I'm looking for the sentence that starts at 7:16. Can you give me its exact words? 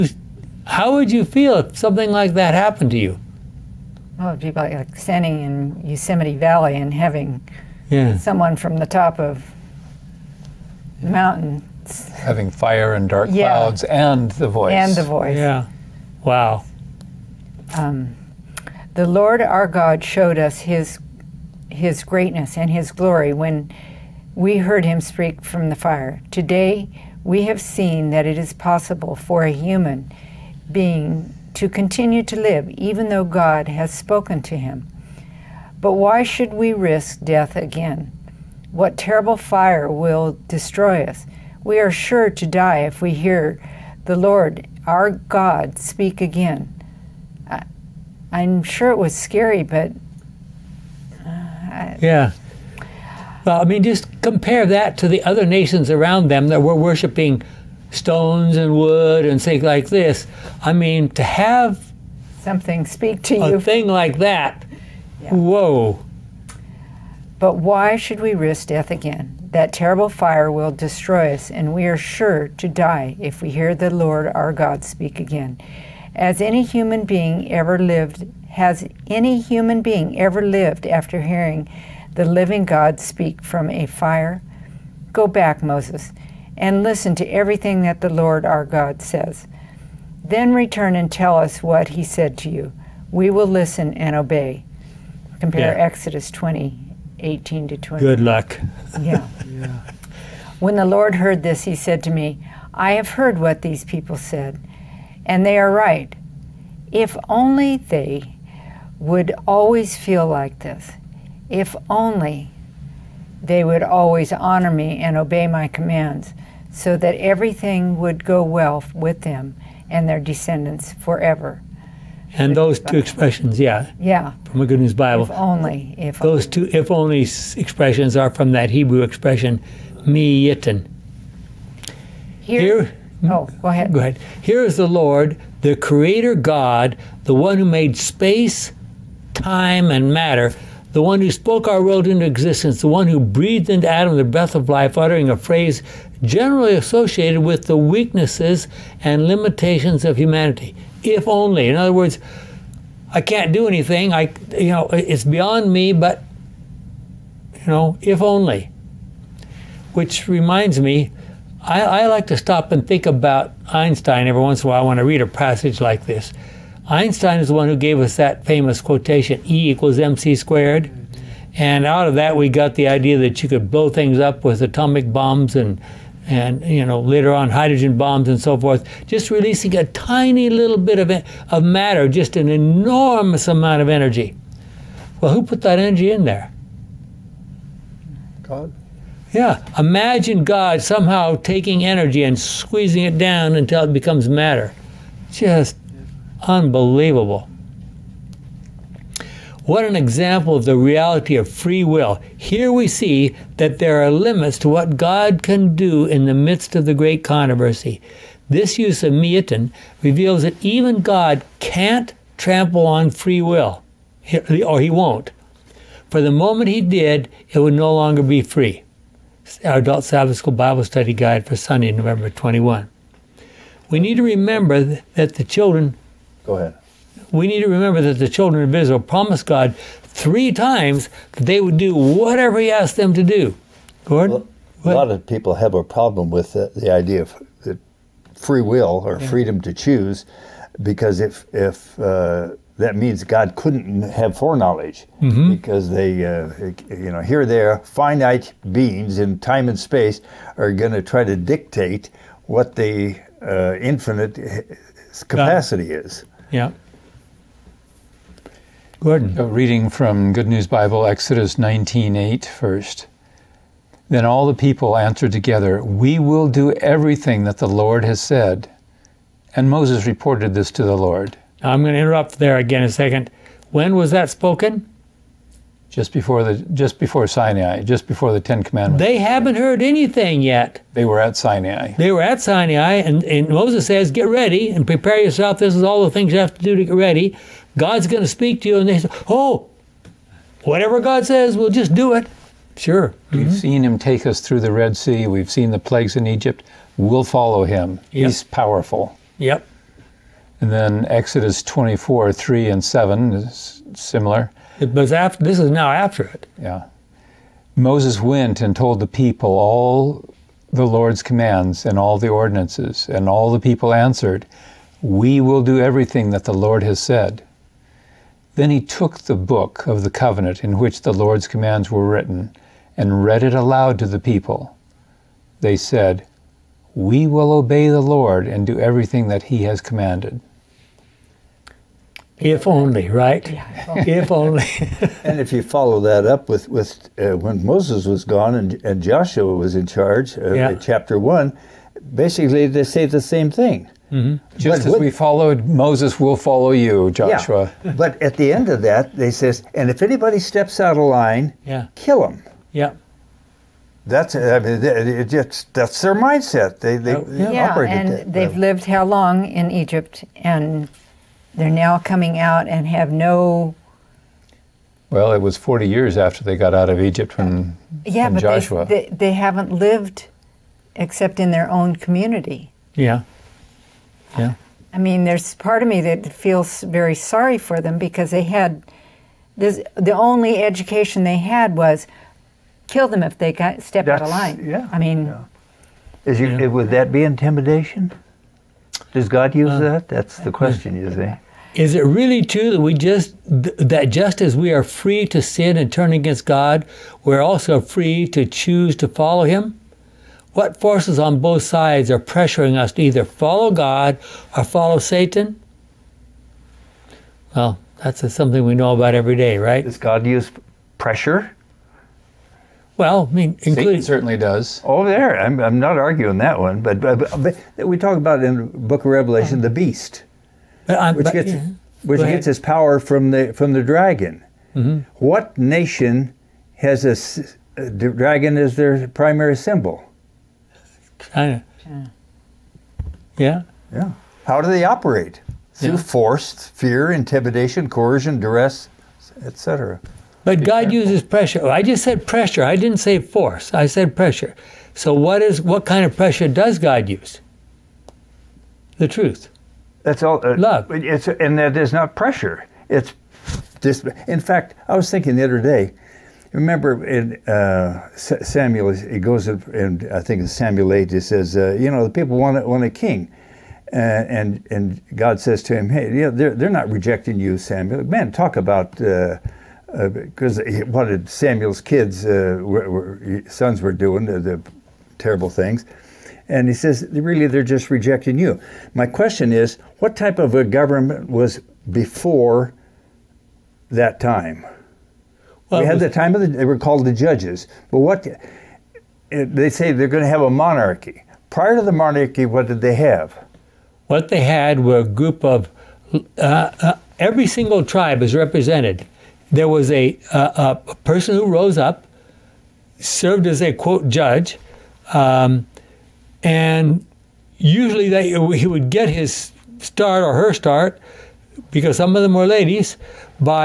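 force, fear, intimidation, coercion, duress, etc.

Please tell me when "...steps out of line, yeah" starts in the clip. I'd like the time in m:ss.
5:50.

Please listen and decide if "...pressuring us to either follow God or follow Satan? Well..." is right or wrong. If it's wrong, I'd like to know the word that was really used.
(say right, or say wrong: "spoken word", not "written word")
right.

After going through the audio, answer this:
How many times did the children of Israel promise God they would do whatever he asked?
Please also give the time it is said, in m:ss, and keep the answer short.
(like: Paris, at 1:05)
3, at 3:50.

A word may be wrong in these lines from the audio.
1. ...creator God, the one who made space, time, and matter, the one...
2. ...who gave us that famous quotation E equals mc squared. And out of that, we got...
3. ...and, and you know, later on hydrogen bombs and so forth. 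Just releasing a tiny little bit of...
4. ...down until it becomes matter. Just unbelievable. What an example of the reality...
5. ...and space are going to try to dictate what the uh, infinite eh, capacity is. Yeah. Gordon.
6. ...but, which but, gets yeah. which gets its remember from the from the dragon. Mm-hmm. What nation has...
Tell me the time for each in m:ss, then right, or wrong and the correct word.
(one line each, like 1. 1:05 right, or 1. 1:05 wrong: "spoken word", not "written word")
1. 2:15 right
2. 2:47 right
3. 2:55 right
4. 3:13 right
5. 4:09 right
6. 7:00 wrong: "power", not "remember".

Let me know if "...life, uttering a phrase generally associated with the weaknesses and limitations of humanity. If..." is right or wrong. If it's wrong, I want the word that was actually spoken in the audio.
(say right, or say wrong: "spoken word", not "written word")
right.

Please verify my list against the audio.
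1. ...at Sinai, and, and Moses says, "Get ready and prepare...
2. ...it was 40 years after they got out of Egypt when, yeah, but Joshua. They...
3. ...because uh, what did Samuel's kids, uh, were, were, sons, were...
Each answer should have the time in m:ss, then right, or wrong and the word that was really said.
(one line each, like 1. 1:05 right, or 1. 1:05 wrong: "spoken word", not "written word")
1. 4:42 right
2. 6:05 right
3. 7:50 right.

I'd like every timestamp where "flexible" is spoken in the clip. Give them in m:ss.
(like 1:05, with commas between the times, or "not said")
not said.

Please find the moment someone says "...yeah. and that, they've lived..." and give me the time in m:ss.
5:57.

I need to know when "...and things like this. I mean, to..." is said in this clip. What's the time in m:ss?
0:59.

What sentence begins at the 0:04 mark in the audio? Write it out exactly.
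Well, it'd be like standing in Yosemite Valley and having yeah.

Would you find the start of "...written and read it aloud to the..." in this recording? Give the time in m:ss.
5:22.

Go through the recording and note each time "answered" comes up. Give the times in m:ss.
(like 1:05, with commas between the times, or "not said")
4:24, 5:13.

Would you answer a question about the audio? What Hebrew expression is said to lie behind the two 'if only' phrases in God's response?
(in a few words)
miyitin.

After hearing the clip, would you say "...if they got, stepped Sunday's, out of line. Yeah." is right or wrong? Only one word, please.
wrong.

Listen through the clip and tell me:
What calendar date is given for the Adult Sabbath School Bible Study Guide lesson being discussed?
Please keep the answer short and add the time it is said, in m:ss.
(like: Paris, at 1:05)
November 21, at 3:41.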